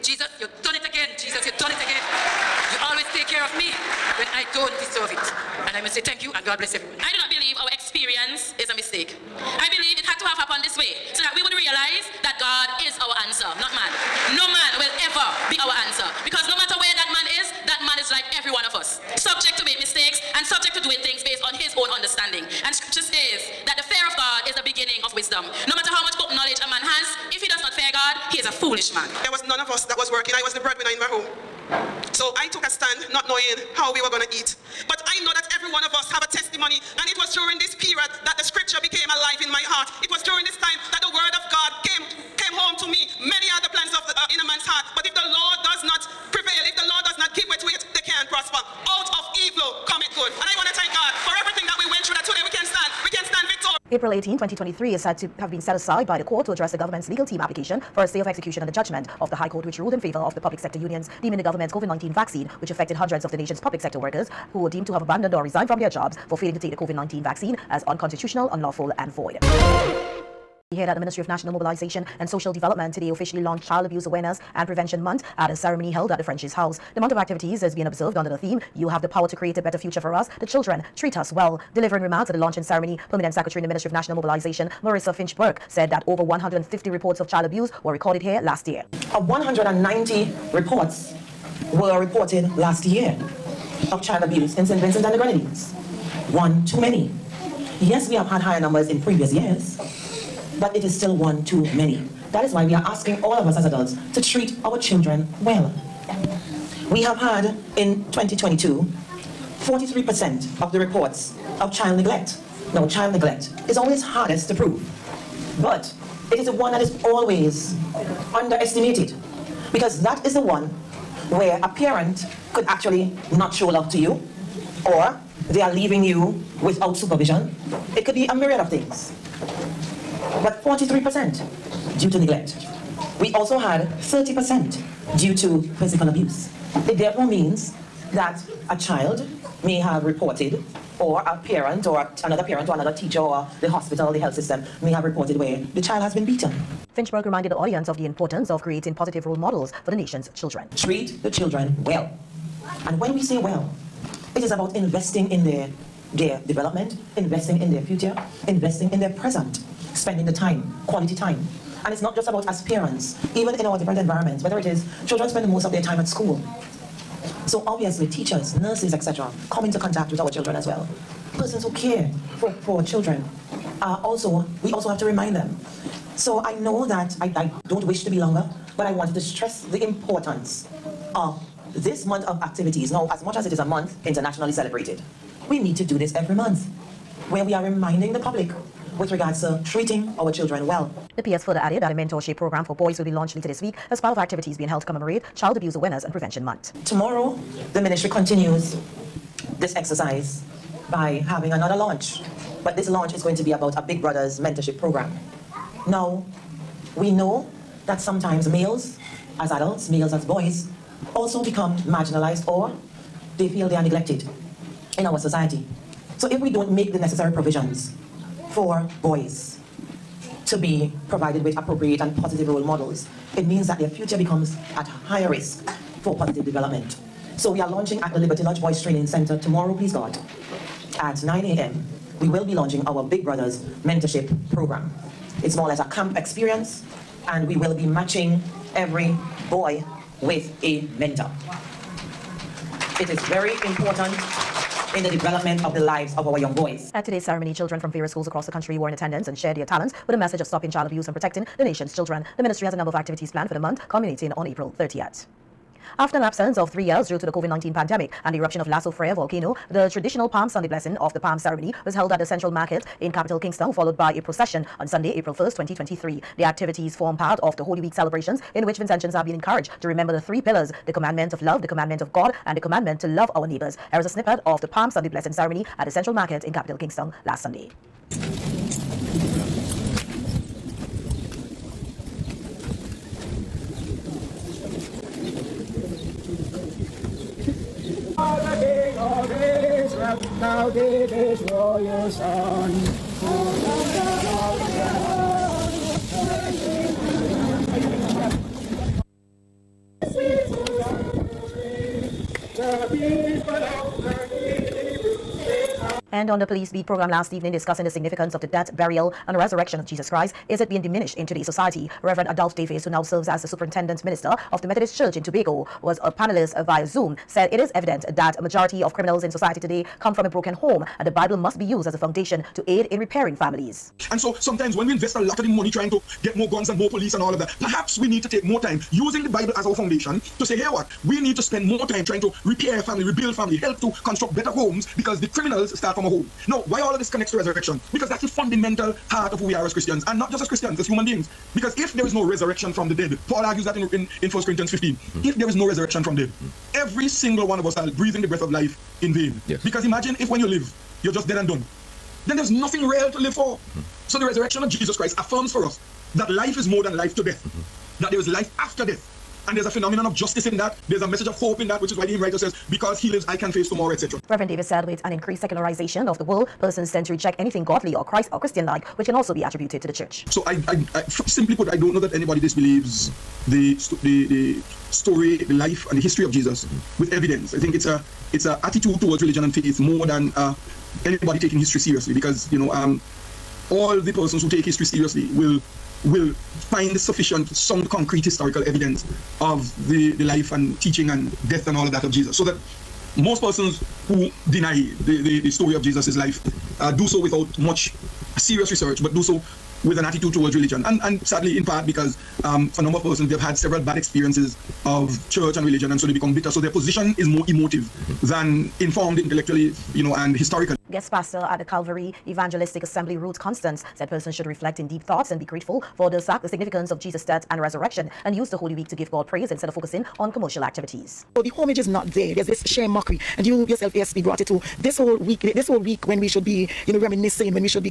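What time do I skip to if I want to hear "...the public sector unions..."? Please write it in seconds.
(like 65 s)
60 s.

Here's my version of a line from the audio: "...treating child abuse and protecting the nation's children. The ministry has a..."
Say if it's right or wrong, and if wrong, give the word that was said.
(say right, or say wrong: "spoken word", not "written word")
wrong: "stopping", not "treating".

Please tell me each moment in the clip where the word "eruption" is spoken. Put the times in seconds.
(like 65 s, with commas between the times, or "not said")
258 s.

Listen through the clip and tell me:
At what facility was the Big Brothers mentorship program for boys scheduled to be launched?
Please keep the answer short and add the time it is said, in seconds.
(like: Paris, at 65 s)
Liberty Lodge Boys Training Center, at 228 s.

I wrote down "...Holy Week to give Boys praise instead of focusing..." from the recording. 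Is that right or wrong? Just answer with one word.
wrong.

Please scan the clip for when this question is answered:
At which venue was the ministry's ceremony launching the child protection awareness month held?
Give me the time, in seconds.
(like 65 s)
76 s.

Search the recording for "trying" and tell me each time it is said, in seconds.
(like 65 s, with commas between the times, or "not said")
325 s, 332 s.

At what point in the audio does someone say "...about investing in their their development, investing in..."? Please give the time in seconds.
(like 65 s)
154 s.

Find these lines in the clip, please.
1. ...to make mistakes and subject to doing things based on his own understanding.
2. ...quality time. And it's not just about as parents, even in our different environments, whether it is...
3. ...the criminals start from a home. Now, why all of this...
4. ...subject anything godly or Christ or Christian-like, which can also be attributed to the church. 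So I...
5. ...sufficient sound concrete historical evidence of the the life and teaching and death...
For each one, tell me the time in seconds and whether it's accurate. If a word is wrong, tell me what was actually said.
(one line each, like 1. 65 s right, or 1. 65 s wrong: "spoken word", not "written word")
1. 19 s right
2. 160 s right
3. 335 s right
4. 367 s wrong: "reject", not "subject"
5. 386 s right.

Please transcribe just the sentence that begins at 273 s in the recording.
Here is a snippet of the Palm Sunday Blessing Ceremony at the Central Market in Capital Kingstown last Sunday.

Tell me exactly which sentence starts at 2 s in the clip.
You always take care of me when I don't deserve it.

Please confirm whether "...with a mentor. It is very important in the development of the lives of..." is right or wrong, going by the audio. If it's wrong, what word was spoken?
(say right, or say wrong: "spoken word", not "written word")
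right.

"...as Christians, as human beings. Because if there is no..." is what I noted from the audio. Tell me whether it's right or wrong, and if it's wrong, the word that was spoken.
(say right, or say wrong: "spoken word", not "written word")
right.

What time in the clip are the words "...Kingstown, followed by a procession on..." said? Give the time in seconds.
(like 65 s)
263 s.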